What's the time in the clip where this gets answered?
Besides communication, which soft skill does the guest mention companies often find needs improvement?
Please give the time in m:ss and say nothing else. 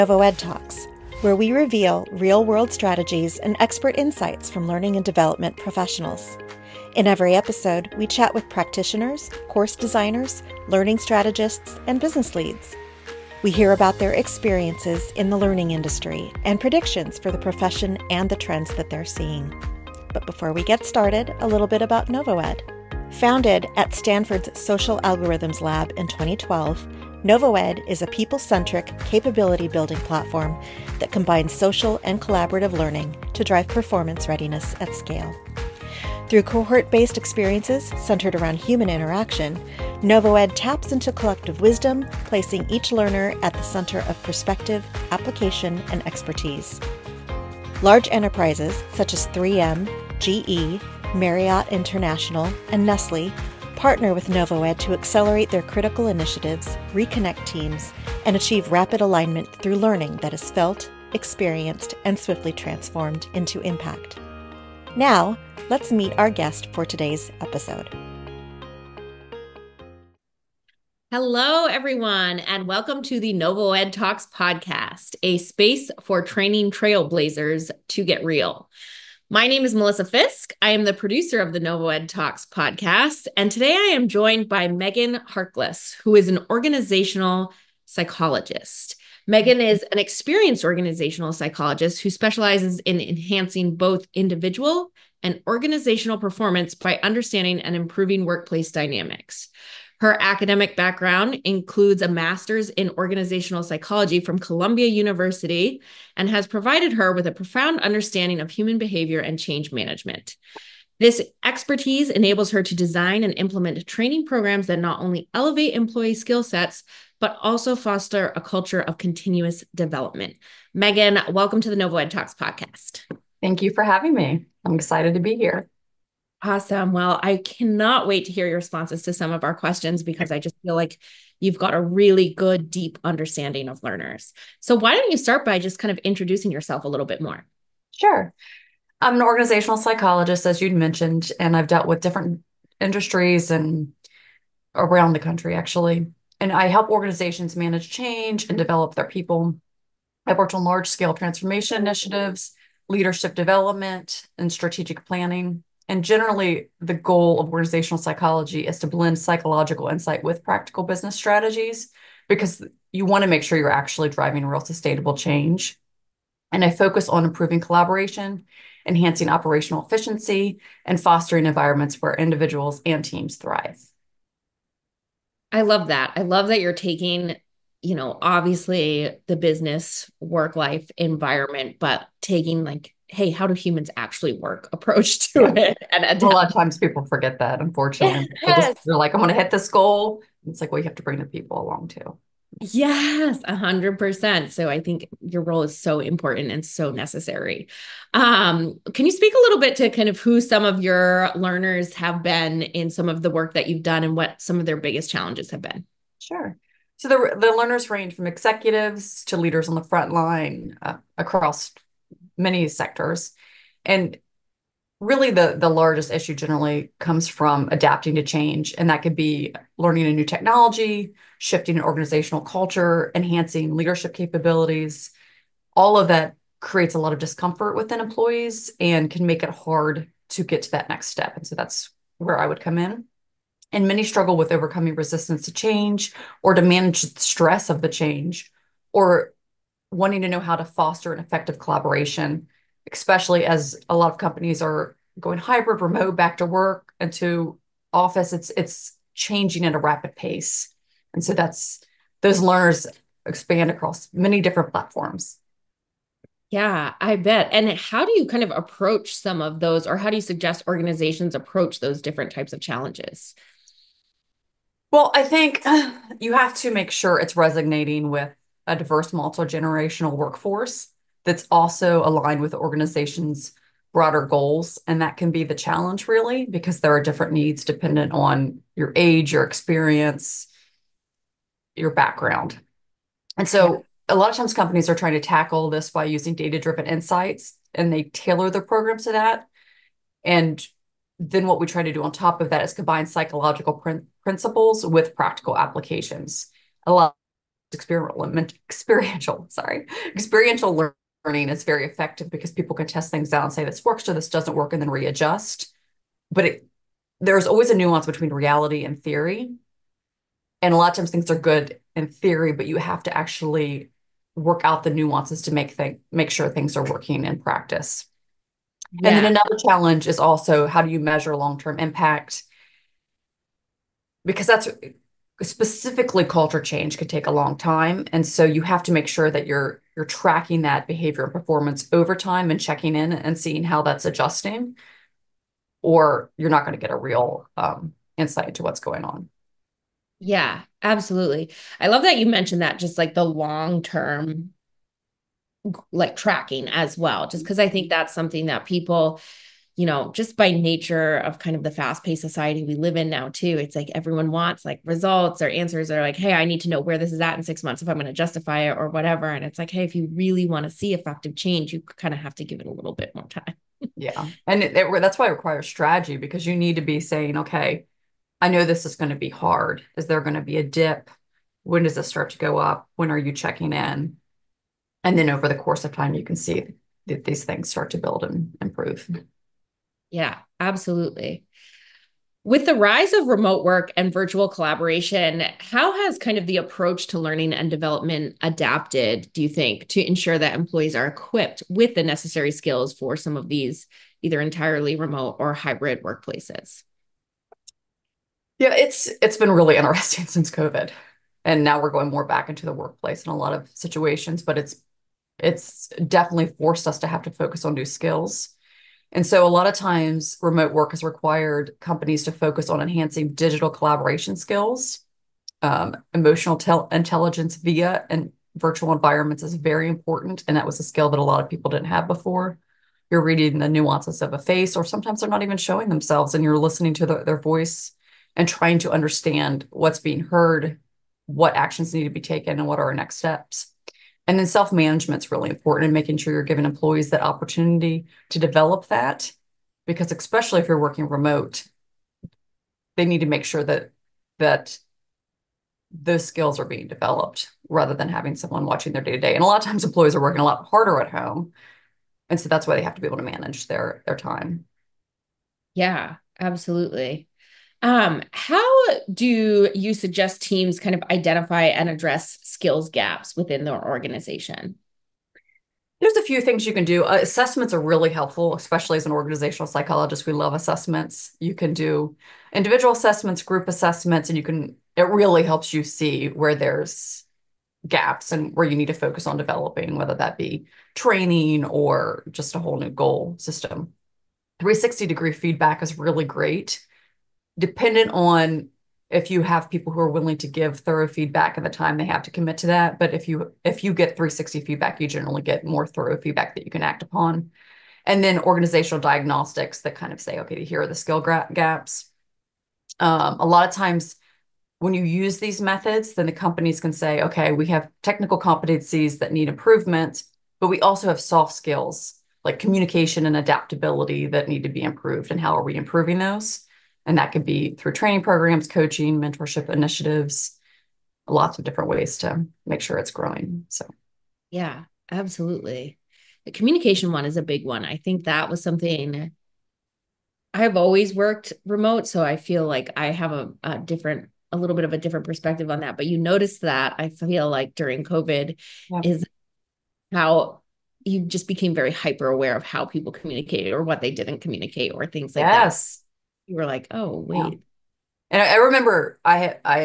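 8:33.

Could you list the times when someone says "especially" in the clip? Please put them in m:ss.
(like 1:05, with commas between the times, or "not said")
4:02, 7:20, 7:48.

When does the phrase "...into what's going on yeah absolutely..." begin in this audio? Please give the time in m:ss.
5:38.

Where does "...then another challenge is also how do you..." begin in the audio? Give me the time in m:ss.
5:19.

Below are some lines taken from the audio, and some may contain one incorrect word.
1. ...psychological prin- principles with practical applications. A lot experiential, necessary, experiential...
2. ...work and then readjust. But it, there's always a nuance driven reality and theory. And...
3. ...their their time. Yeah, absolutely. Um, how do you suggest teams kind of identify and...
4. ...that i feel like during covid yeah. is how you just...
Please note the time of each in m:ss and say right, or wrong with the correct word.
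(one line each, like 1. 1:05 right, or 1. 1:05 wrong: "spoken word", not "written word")
1. 4:53 wrong: "sorry", not "necessary"
2. 5:04 wrong: "between", not "driven"
3. 7:33 right
4. 8:56 right.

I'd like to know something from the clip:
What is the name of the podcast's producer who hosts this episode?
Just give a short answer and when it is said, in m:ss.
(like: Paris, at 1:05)
Melissa Fisk, at 1:19.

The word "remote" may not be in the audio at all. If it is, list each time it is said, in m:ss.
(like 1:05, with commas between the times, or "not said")
4:05, 6:23, 6:34, 6:50, 7:21, 8:51.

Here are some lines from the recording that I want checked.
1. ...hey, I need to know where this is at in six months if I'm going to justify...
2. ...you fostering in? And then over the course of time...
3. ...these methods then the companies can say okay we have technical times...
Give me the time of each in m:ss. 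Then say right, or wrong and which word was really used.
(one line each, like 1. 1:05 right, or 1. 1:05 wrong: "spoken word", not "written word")
1. 5:56 right
2. 6:13 wrong: "checking", not "fostering"
3. 8:25 wrong: "competencies", not "times".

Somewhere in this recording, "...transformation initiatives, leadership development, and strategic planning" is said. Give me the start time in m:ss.
2:31.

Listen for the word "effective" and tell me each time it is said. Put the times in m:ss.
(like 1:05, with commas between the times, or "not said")
4:01, 5:01, 6:00.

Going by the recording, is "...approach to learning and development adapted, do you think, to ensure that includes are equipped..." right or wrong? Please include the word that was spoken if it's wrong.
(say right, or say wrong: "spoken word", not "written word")
wrong: "employees", not "includes".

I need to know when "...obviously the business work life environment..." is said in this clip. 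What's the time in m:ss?
2:58.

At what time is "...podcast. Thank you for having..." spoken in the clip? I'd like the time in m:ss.
2:02.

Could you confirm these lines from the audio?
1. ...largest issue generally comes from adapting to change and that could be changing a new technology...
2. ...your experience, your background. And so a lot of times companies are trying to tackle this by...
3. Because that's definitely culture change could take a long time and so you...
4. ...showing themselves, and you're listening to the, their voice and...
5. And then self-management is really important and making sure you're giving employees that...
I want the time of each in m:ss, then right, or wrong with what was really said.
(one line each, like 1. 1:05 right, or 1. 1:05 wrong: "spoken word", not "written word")
1. 3:35 wrong: "learning", not "changing"
2. 4:39 right
3. 5:24 wrong: "specifically", not "definitely"
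4. 7:05 right
5. 7:14 right.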